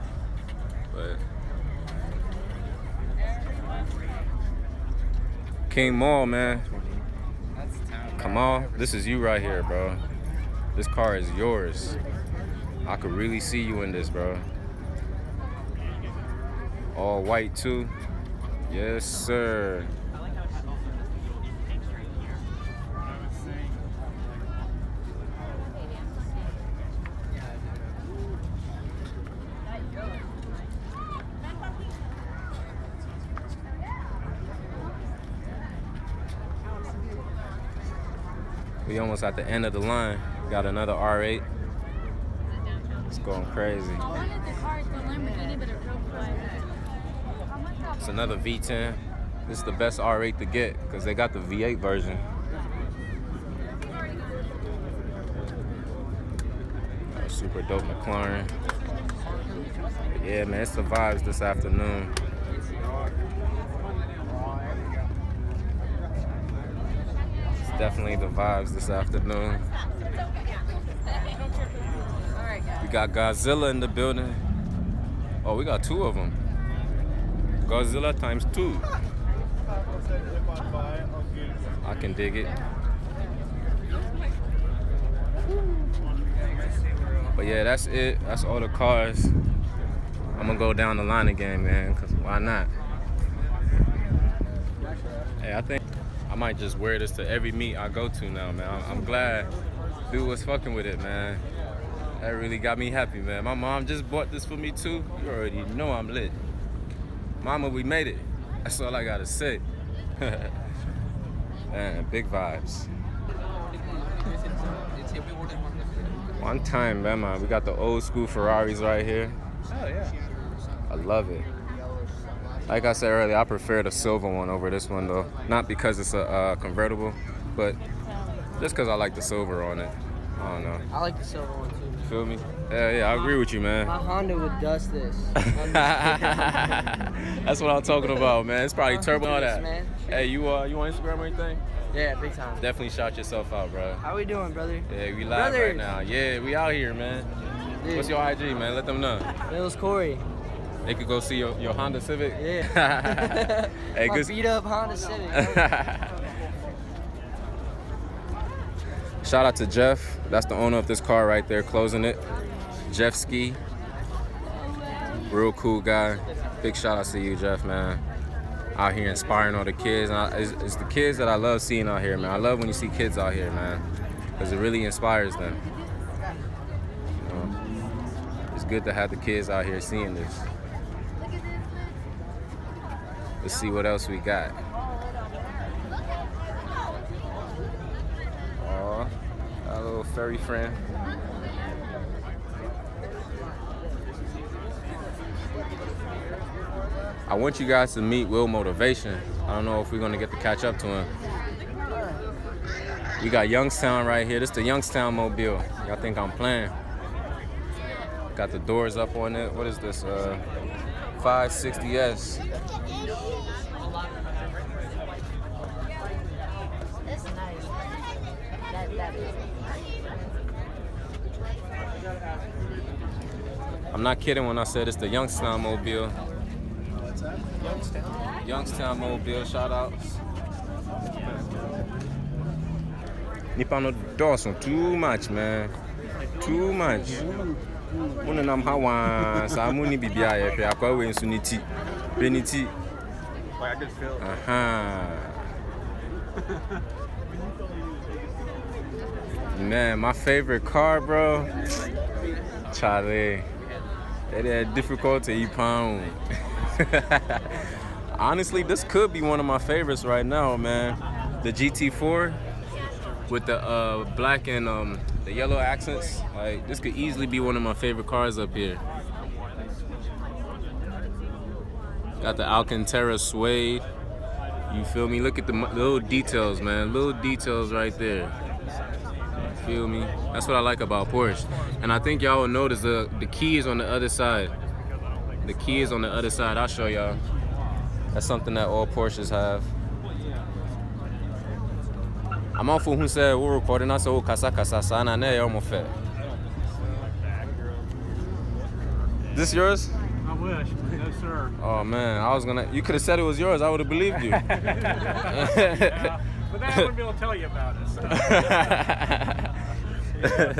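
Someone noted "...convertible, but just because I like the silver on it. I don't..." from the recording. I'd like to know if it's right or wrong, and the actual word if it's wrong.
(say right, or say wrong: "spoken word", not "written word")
right.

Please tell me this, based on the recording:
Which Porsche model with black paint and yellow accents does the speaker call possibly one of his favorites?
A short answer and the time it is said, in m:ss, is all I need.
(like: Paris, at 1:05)
GT4, at 4:21.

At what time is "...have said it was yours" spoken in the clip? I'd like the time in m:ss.
5:02.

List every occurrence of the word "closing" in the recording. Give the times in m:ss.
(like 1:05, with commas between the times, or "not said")
2:41.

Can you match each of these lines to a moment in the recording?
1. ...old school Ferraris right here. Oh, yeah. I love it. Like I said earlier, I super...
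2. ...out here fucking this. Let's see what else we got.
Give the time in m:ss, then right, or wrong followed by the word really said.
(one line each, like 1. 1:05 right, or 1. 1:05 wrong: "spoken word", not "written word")
1. 1:57 wrong: "prefer", not "super"
2. 2:59 wrong: "seeing", not "fucking".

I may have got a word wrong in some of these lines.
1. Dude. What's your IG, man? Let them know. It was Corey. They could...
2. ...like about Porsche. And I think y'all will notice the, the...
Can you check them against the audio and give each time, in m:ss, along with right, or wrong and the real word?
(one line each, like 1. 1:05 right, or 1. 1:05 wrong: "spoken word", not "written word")
1. 2:27 right
2. 4:40 right.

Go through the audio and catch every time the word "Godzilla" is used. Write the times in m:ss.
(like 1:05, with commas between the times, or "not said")
1:13, 1:17.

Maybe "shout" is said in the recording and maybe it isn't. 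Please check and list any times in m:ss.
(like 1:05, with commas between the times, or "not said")
2:22, 2:39, 2:46, 3:49.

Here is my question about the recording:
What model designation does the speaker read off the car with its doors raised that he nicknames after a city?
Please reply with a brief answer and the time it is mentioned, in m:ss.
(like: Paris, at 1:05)
560S, at 3:31.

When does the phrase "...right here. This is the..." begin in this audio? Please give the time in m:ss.
3:24.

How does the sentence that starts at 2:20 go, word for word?
Hey, you uh, you on Instagram or anything?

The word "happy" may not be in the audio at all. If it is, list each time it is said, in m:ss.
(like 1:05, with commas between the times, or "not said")
1:42.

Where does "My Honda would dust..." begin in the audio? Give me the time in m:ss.
2:13.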